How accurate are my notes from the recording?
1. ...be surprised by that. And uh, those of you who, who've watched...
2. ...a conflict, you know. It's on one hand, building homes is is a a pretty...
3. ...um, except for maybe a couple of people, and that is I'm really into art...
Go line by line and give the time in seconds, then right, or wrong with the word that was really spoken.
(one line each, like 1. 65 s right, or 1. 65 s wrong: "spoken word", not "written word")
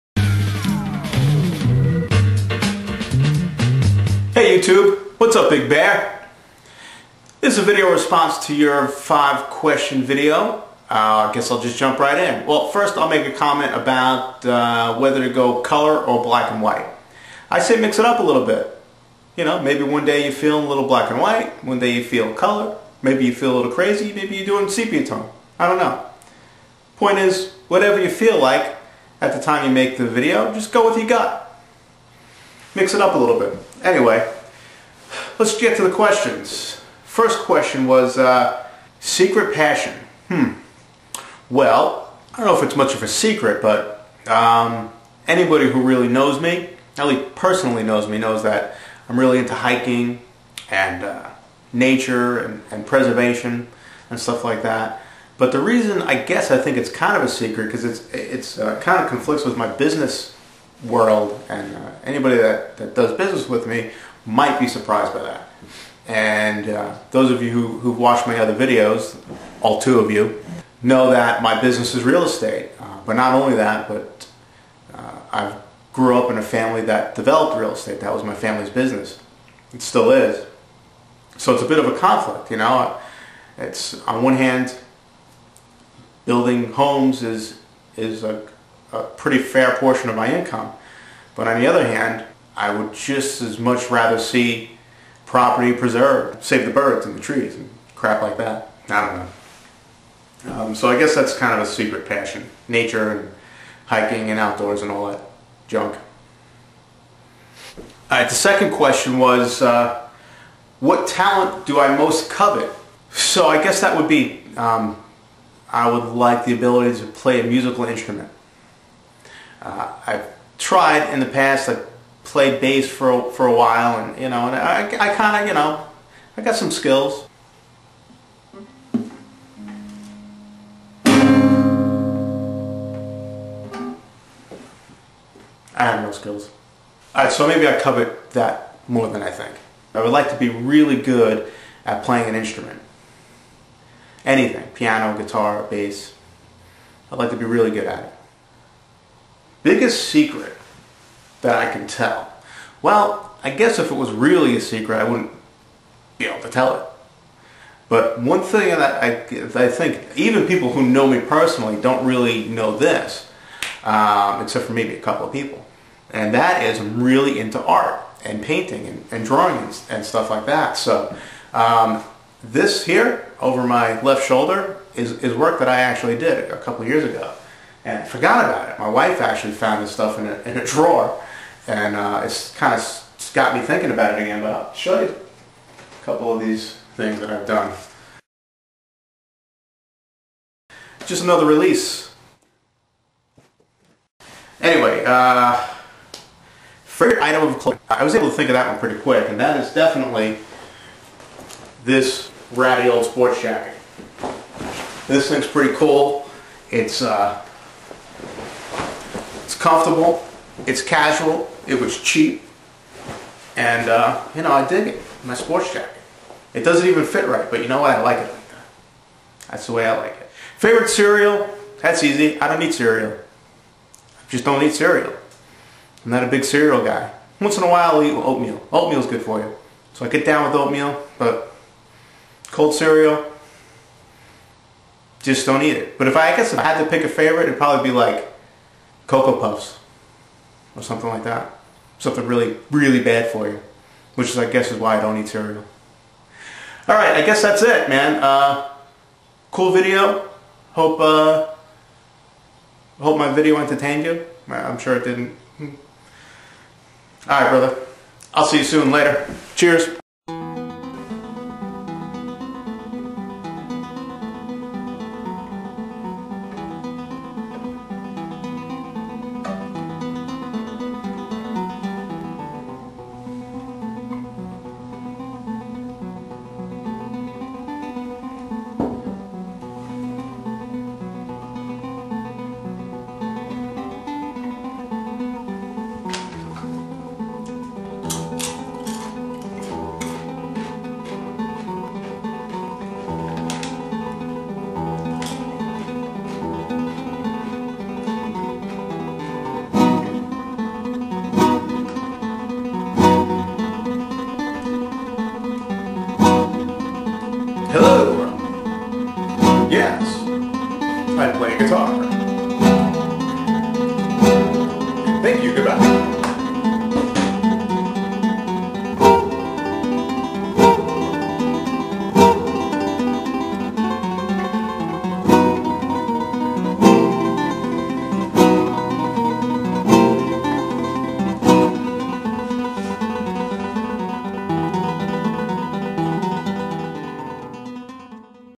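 1. 64 s right
2. 81 s right
3. 163 s right.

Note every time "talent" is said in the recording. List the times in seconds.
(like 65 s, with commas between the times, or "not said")
111 s.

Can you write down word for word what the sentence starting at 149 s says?
Biggest secret that I can tell.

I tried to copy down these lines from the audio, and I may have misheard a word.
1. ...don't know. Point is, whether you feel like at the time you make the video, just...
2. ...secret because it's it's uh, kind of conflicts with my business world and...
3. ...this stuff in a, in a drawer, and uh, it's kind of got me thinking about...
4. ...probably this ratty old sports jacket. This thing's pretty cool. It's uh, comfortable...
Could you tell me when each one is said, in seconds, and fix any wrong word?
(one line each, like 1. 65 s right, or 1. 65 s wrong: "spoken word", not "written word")
1. 25 s wrong: "whatever", not "whether"
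2. 57 s right
3. 179 s right
4. 199 s wrong: "definitely", not "probably".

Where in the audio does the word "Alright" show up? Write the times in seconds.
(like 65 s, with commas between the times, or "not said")
137 s.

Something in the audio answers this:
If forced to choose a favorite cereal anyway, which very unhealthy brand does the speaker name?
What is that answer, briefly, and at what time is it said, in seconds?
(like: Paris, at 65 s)
Cocoa Puffs, at 239 s.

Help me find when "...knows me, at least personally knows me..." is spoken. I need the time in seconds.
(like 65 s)
46 s.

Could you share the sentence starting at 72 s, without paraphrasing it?
Uh, but not only that, but uh, I grew up in a family that developed real estate.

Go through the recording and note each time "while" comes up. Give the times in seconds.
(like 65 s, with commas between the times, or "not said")
123 s, 227 s.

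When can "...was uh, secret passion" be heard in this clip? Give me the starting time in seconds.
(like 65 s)
37 s.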